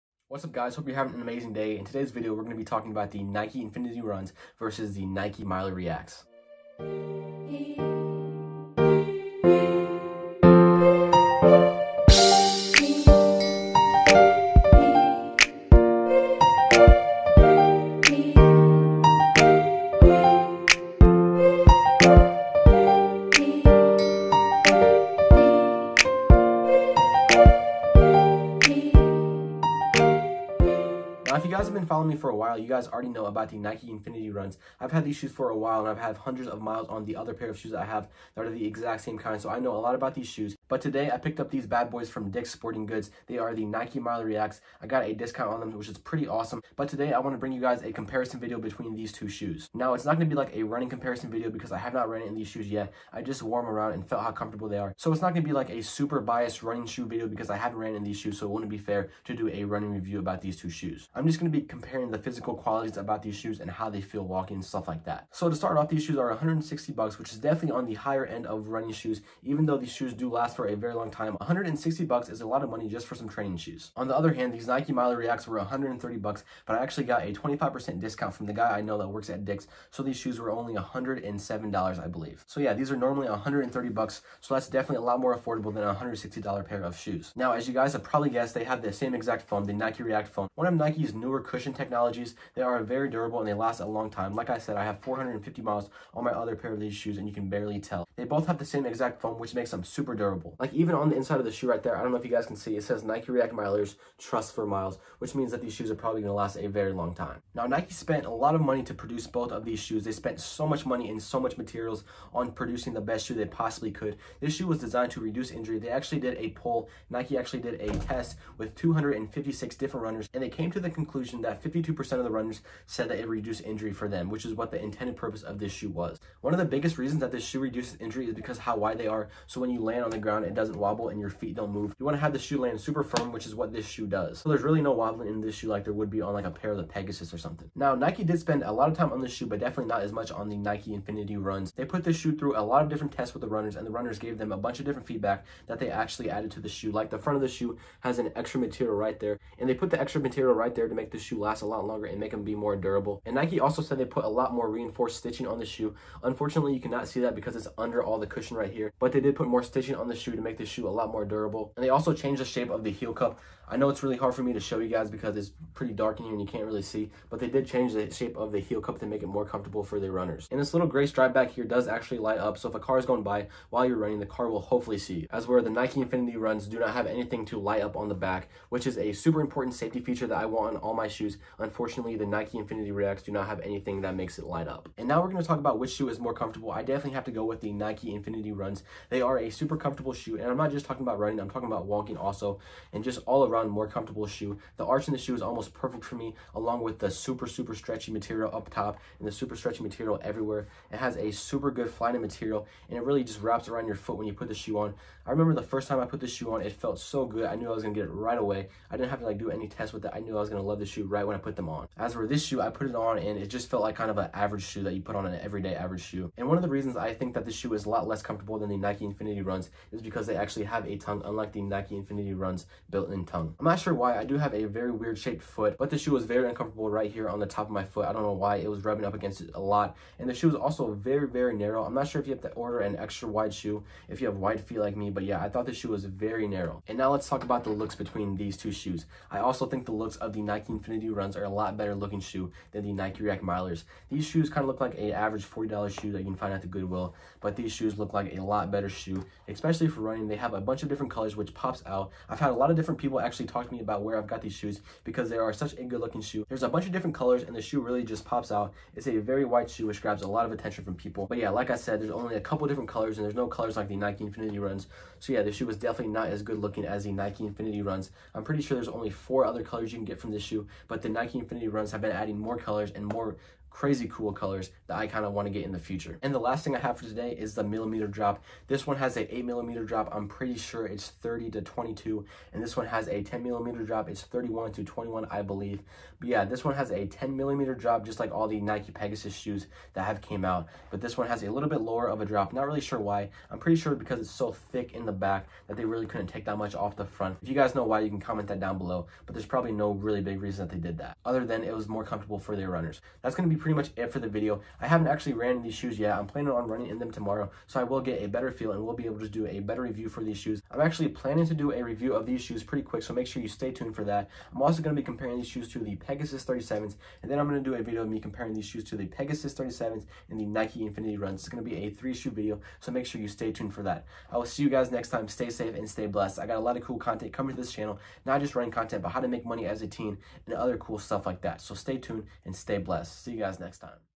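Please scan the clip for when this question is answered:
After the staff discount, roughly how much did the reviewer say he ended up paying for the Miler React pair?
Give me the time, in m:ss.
1:20.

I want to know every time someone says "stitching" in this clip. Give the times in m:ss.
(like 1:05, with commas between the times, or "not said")
2:35, 2:39.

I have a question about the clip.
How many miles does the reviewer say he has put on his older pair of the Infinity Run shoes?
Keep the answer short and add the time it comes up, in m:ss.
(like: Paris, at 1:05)
450, at 1:34.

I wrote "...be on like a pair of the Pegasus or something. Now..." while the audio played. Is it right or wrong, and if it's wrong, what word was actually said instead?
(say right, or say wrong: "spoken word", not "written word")
right.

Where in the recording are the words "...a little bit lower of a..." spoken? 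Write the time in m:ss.
4:51.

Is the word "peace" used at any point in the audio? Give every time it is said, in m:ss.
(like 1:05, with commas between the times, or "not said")
not said.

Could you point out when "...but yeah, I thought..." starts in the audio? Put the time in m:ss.
3:55.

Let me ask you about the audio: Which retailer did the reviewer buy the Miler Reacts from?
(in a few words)
Dick's Sporting Goods.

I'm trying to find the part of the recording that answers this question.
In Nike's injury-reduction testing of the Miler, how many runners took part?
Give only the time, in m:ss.
1:58.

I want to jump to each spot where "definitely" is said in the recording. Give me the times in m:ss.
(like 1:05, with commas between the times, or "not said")
1:07, 1:24, 2:19, 3:06, 4:25.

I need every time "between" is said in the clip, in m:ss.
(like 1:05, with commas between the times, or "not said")
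0:48, 3:57.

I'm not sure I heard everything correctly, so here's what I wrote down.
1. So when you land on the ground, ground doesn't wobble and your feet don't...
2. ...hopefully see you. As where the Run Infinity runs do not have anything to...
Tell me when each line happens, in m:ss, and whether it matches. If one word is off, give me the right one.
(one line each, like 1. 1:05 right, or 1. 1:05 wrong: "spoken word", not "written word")
1. 2:09 right
2. 2:54 wrong: "Nike", not "Run".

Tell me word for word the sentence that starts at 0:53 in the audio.
I just wore them around and felt how comfortable they are.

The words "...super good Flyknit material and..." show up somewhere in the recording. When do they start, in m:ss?
3:21.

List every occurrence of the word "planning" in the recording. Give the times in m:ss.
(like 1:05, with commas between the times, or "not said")
5:06, 5:11.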